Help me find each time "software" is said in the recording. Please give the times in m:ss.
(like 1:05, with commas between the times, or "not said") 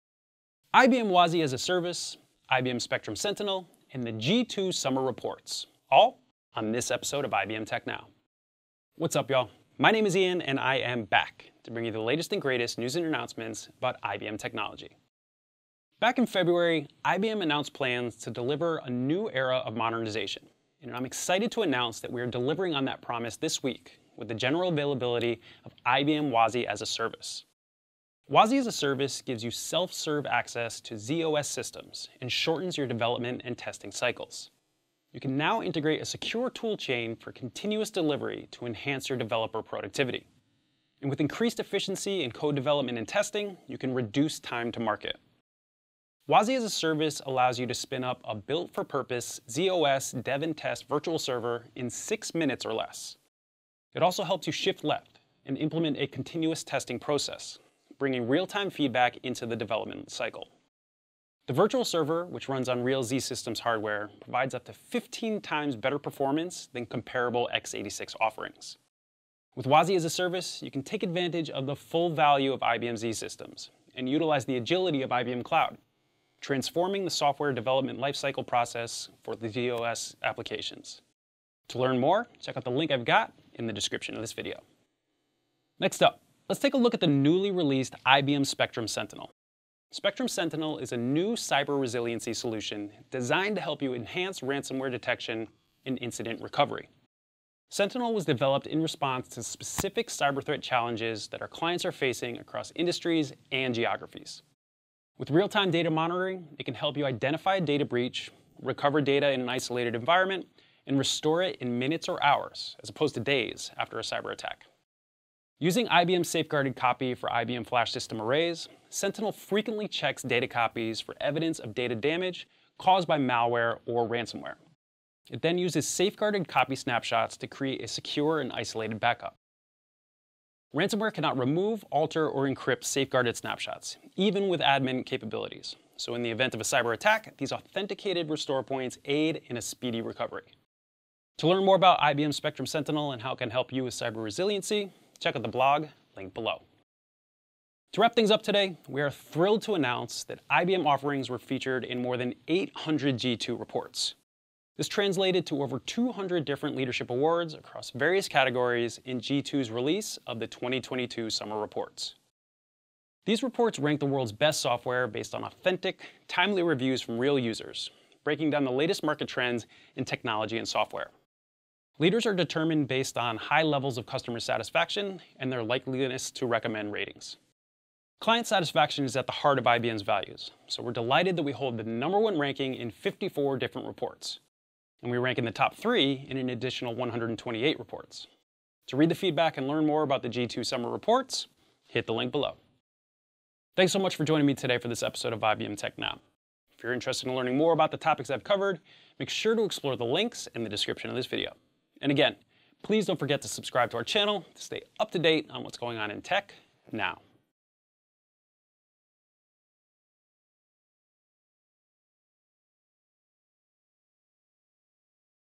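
1:17, 2:44, 2:50.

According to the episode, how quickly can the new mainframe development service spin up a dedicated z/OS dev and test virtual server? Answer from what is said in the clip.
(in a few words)
6 minutes or less.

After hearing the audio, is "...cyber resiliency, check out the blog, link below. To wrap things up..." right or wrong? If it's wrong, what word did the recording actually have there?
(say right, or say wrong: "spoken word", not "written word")
right.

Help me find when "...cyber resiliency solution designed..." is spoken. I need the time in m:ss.
1:31.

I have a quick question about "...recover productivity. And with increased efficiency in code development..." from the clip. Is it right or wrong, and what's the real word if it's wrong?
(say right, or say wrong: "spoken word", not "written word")
wrong: "developer", not "recover".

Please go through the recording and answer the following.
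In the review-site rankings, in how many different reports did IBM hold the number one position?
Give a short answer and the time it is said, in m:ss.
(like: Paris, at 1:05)
54, at 3:02.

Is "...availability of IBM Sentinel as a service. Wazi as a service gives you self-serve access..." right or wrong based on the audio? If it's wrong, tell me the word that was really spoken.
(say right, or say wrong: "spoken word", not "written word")
wrong: "Wazi", not "Sentinel".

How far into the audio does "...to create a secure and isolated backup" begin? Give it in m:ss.
2:07.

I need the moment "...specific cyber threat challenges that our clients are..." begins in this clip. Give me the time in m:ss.
1:39.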